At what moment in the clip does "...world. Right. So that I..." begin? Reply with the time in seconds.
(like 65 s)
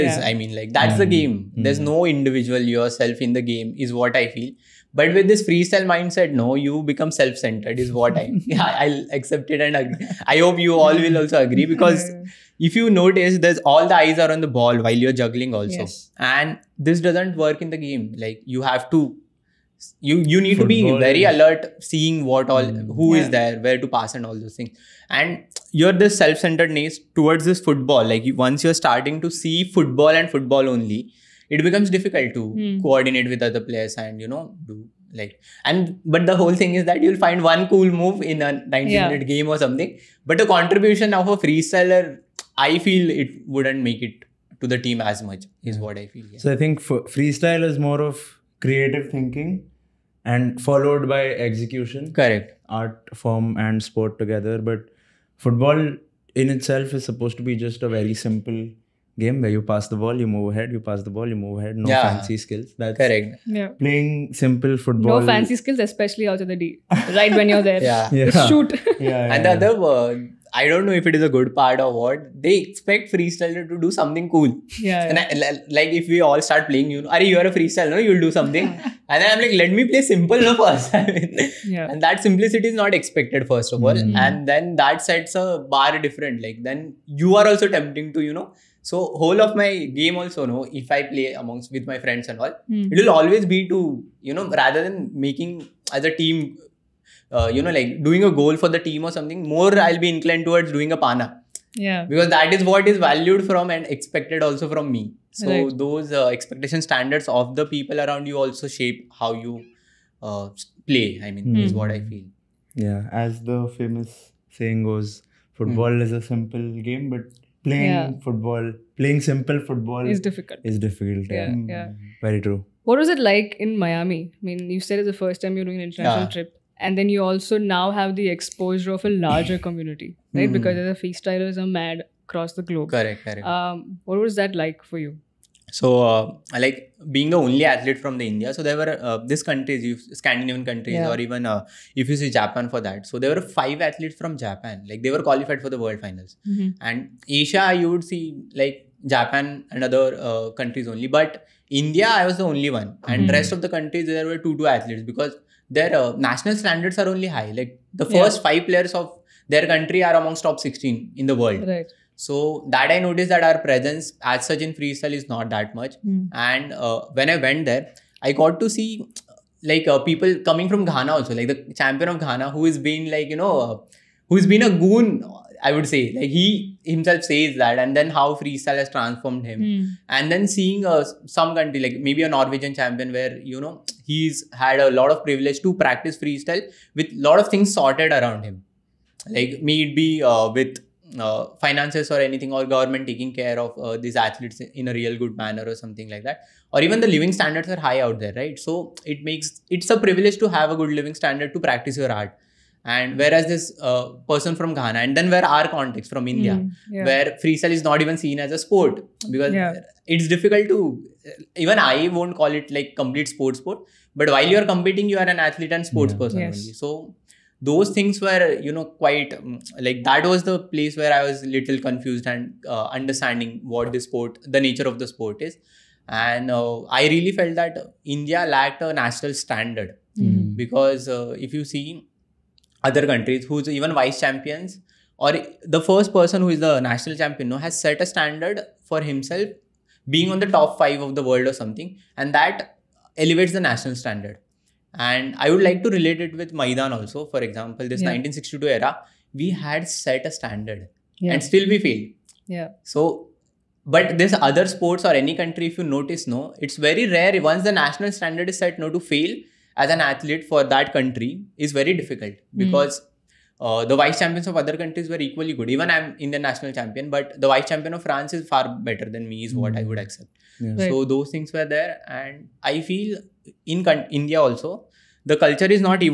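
161 s.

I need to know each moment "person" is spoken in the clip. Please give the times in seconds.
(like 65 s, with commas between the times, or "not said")
204 s, 216 s, 236 s.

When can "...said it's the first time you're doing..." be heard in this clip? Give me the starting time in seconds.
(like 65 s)
124 s.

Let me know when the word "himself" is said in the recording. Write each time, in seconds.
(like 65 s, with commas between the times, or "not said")
176 s, 239 s.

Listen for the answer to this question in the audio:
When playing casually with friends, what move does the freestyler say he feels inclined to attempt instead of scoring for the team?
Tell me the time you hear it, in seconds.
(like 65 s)
100 s.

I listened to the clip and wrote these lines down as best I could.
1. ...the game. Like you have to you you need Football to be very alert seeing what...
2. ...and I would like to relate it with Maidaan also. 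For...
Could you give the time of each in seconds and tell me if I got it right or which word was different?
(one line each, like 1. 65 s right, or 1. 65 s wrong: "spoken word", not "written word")
1. 17 s right
2. 244 s right.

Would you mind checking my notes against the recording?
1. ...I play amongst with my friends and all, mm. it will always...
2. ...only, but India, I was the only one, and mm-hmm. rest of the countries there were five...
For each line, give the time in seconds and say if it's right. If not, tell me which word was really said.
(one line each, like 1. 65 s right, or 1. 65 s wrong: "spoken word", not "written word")
1. 90 s right
2. 150 s wrong: "two", not "five".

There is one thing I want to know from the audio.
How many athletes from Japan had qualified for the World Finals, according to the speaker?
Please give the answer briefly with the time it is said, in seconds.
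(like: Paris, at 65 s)
5, at 143 s.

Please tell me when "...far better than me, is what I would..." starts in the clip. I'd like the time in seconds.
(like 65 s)
268 s.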